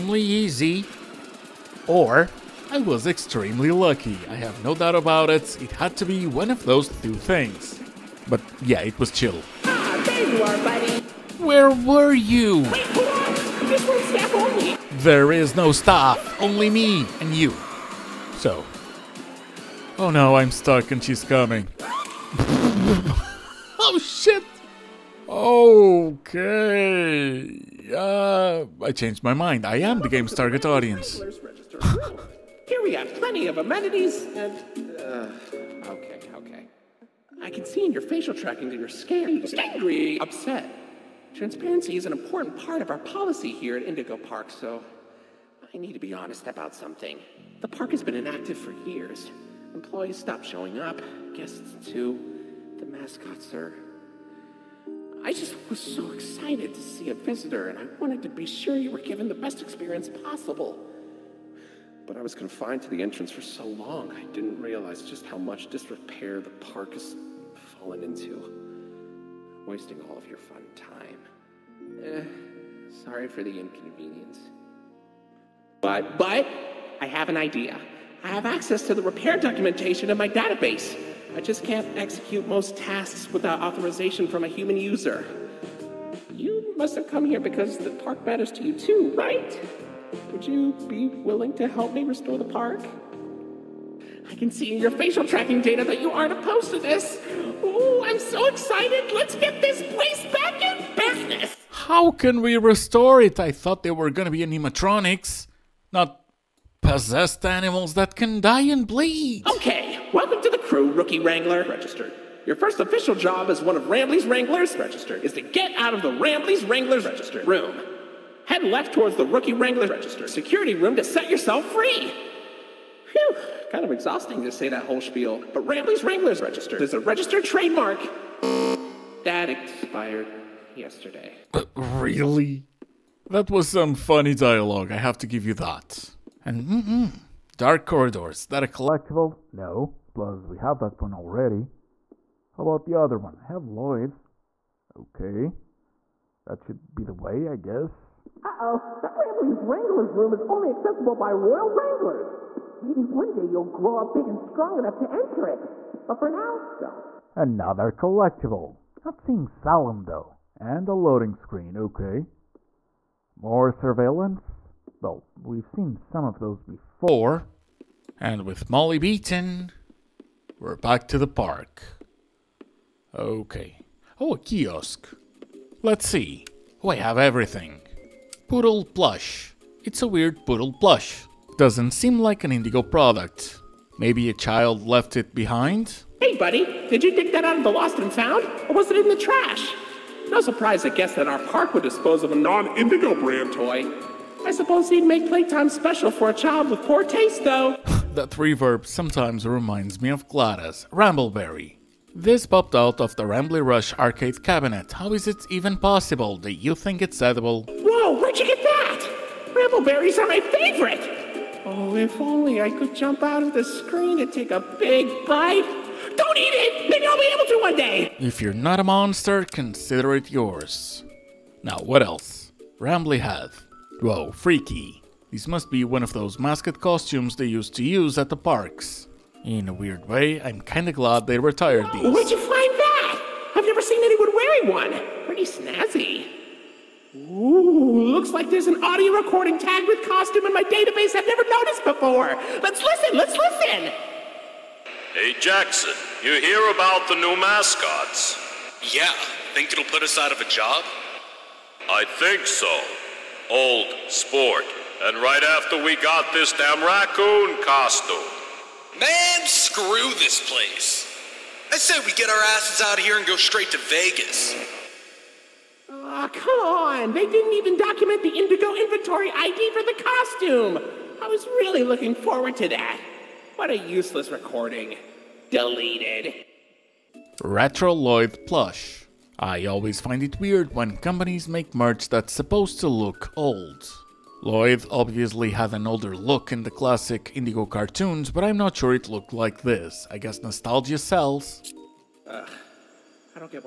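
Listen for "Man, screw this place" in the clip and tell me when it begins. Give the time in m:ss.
4:18.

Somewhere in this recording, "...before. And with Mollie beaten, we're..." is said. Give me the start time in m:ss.
2:46.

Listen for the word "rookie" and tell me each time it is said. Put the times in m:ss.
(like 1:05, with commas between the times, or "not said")
1:50, 1:59.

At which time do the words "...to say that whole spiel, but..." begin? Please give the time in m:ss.
2:04.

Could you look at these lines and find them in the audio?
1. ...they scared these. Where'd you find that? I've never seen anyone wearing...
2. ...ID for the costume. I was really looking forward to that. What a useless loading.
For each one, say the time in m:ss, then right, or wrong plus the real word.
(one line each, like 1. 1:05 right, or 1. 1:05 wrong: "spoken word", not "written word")
1. 3:51 wrong: "retired", not "scared"
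2. 4:29 wrong: "recording", not "loading".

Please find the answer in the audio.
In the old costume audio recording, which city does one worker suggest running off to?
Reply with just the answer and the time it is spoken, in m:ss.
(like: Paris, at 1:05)
Vegas, at 4:23.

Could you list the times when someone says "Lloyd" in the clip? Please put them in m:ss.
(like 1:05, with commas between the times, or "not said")
2:23, 4:44.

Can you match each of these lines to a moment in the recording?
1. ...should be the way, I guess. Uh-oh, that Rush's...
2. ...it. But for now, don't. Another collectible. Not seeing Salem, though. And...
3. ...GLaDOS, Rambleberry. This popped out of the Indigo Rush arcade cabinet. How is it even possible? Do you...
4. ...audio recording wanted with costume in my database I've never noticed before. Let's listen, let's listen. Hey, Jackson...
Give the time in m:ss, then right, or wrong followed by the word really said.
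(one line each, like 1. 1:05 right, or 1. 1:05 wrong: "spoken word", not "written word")
1. 2:26 wrong: "Rambley", not "Rush"
2. 2:35 right
3. 3:20 wrong: "Rambley", not "Indigo"
4. 3:58 wrong: "tagged", not "wanted".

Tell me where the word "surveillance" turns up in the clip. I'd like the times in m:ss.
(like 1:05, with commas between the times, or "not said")
2:43.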